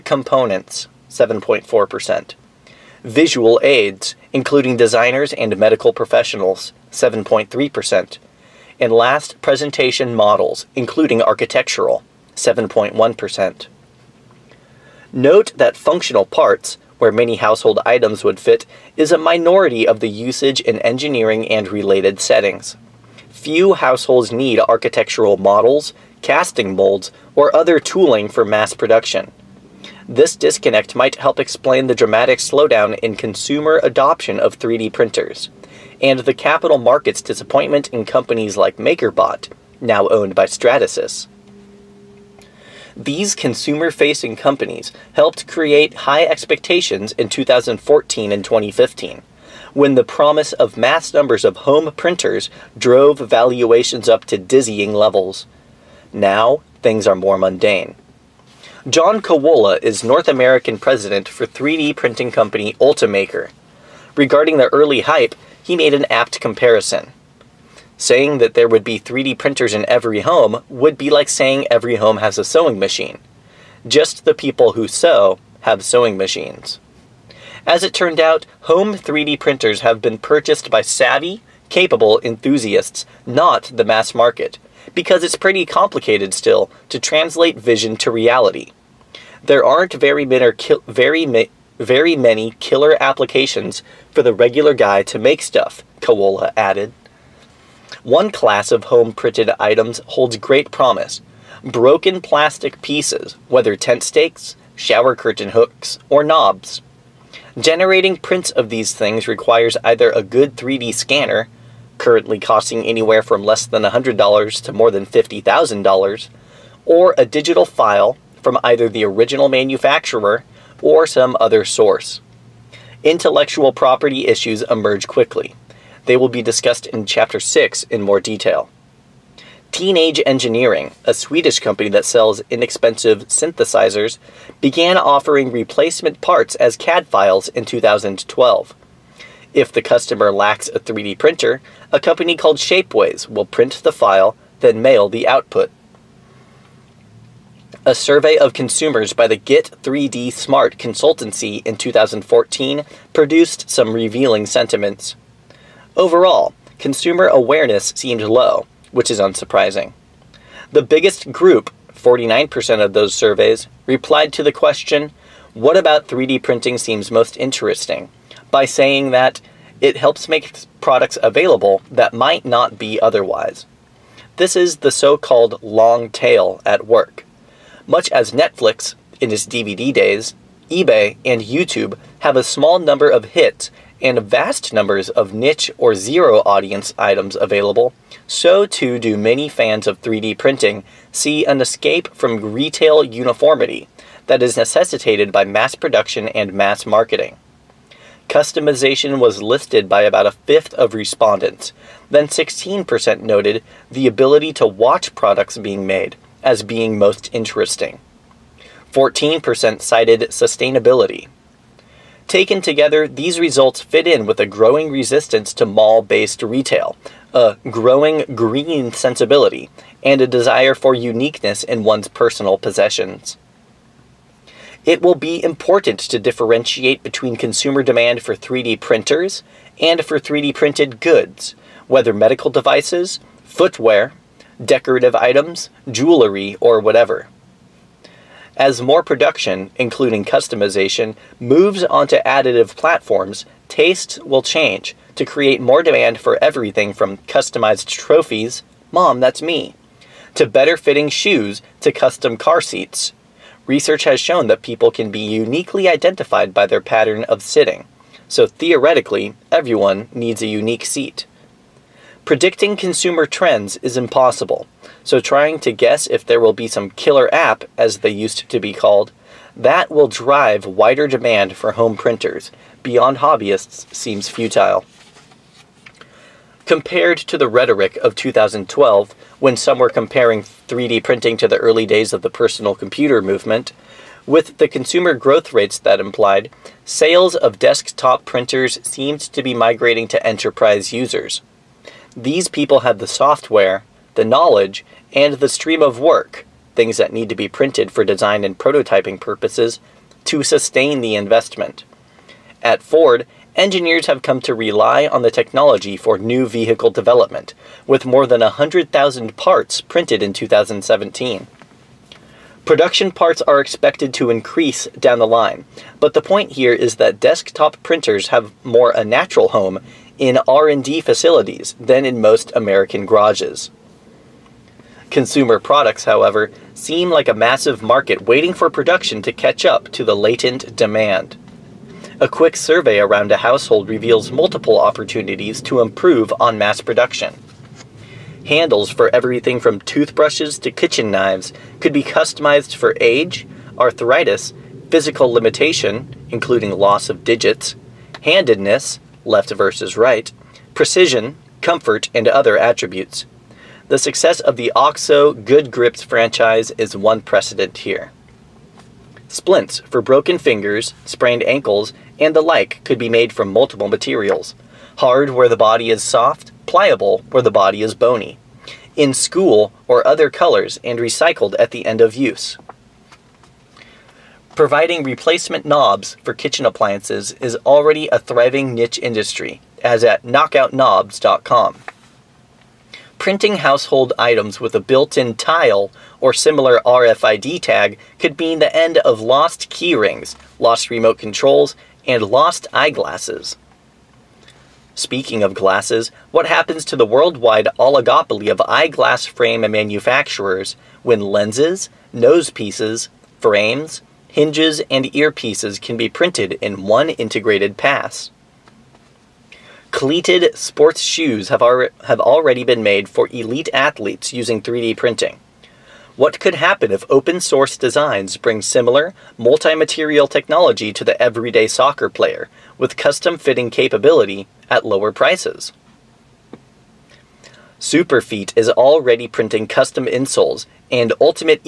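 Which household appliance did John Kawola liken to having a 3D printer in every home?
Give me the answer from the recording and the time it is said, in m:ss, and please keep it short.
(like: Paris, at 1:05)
sewing machine, at 1:12.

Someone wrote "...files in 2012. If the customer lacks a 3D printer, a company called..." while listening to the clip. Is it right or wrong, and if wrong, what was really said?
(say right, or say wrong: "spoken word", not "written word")
right.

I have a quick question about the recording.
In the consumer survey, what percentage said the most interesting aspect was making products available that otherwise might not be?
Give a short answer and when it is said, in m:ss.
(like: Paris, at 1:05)
49%, at 2:41.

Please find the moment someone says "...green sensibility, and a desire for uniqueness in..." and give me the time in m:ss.
3:38.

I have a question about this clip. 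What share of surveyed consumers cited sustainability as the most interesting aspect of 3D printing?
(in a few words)
14%.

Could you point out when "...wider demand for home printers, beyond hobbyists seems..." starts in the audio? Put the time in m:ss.
4:30.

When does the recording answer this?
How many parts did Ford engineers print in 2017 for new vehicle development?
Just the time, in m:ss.
5:08.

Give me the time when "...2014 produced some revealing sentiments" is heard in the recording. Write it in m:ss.
2:31.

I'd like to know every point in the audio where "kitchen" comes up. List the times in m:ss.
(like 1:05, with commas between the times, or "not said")
5:40, 6:16.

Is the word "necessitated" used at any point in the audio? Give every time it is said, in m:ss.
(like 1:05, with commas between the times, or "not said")
3:14.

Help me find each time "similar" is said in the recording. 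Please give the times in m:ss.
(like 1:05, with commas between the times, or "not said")
6:26, 6:58.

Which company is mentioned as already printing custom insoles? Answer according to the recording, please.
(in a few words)
Superfeet.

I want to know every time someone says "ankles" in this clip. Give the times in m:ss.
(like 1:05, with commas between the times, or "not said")
6:01.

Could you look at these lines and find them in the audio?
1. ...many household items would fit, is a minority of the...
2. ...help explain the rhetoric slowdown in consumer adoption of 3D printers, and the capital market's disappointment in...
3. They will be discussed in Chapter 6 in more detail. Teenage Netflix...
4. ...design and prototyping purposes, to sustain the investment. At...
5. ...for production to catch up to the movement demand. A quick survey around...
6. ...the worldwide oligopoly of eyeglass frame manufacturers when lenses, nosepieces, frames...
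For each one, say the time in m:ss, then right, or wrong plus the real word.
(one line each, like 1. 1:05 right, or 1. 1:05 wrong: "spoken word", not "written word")
1. 0:17 right
2. 0:31 wrong: "dramatic", not "rhetoric"
3. 2:06 wrong: "Engineering", not "Netflix"
4. 4:58 right
5. 5:28 wrong: "latent", not "movement"
6. 6:36 right.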